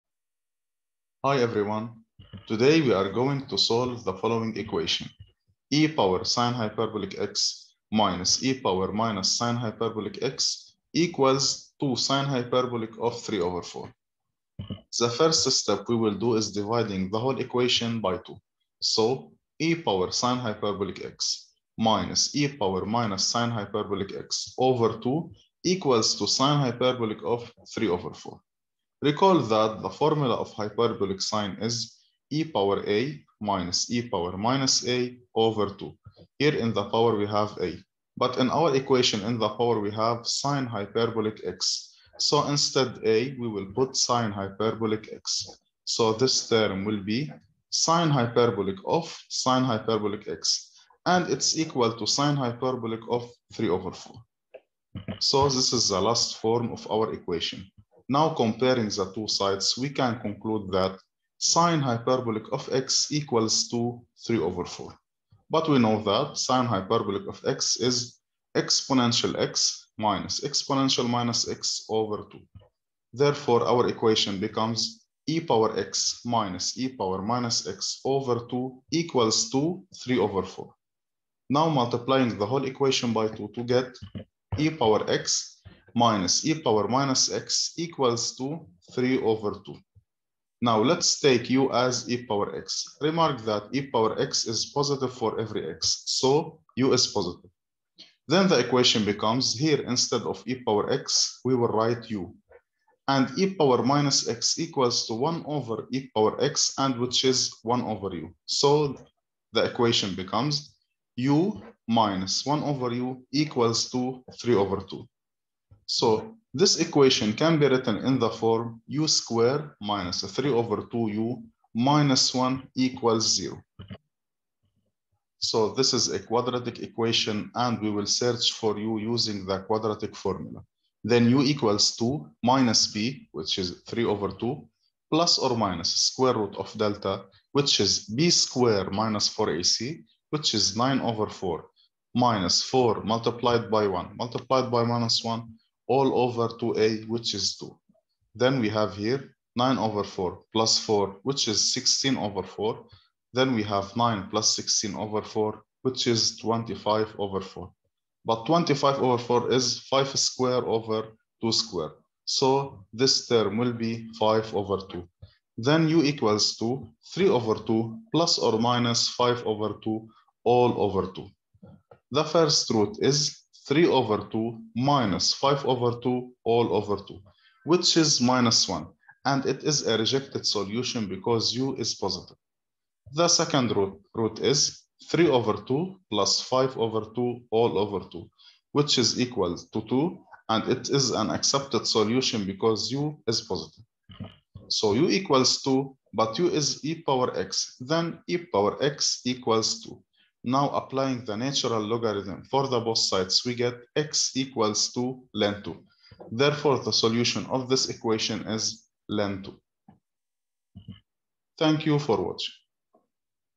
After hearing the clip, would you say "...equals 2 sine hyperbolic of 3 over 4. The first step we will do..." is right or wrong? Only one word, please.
right.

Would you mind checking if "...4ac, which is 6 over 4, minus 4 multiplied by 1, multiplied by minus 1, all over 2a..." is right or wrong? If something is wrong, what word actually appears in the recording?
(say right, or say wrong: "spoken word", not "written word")
wrong: "9", not "6".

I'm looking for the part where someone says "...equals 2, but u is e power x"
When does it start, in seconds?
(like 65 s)
195 s.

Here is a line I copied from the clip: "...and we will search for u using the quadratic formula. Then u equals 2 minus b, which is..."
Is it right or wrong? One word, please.
right.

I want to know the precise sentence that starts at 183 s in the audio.
The second root, root is 3 over 2 plus 5 over 2 all over 2, which is equal to 2.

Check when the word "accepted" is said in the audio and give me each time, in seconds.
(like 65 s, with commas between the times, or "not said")
191 s.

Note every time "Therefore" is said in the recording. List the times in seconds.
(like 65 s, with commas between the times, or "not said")
73 s, 206 s.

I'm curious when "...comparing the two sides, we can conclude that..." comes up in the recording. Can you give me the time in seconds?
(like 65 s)
58 s.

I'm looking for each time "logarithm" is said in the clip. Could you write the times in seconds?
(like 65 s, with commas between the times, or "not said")
201 s.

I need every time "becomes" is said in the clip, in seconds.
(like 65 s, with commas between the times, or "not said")
74 s, 99 s, 110 s.